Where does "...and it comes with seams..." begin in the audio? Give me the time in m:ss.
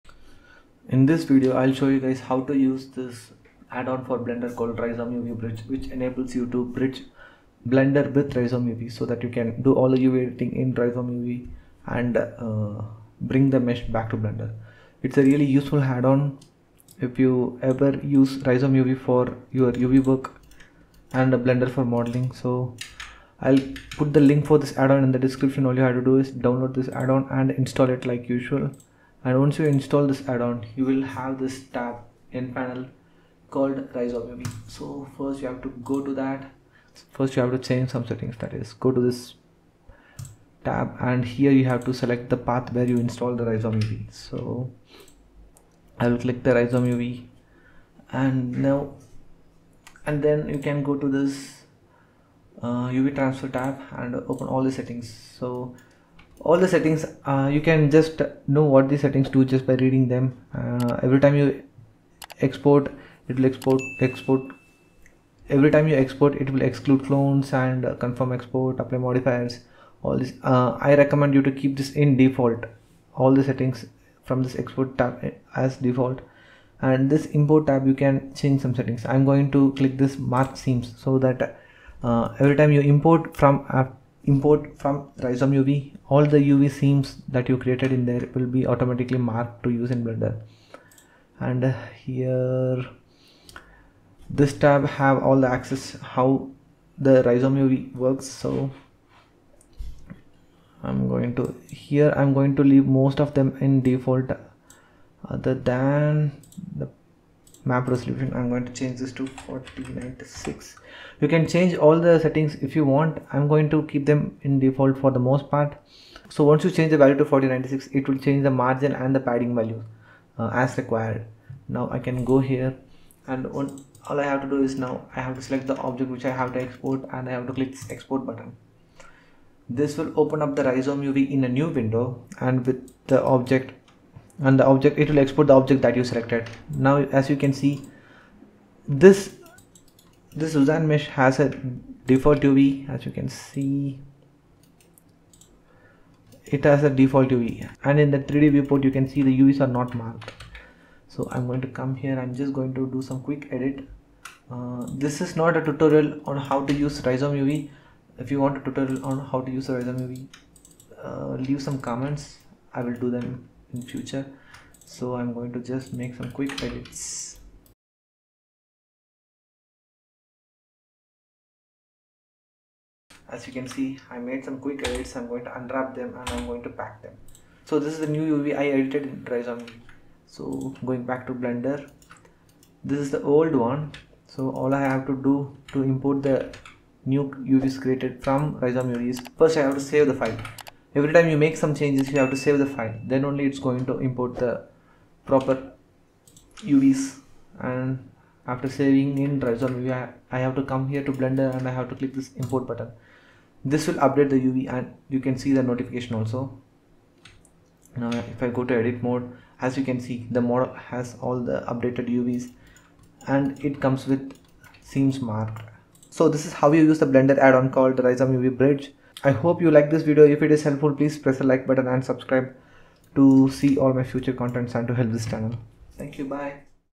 3:33.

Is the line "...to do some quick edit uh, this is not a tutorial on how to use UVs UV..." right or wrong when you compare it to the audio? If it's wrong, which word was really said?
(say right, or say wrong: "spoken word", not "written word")
wrong: "Rizom", not "UVs".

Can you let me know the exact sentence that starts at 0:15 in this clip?
It's a really useful add-on if you ever use Rizom UV for your UV work and Blender for modeling.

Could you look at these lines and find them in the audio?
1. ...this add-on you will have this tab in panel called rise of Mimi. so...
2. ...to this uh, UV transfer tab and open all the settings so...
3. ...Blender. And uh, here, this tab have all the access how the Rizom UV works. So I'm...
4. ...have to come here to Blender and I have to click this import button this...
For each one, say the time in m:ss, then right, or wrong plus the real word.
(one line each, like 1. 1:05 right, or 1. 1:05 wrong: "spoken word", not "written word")
1. 0:30 right
2. 0:50 right
3. 1:30 right
4. 3:20 right.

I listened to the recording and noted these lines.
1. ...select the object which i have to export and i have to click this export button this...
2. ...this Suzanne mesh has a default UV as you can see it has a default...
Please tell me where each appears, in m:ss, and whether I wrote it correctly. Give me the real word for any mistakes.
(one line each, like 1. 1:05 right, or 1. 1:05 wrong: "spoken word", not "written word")
1. 2:05 right
2. 2:20 right.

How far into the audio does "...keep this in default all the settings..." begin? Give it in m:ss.
1:11.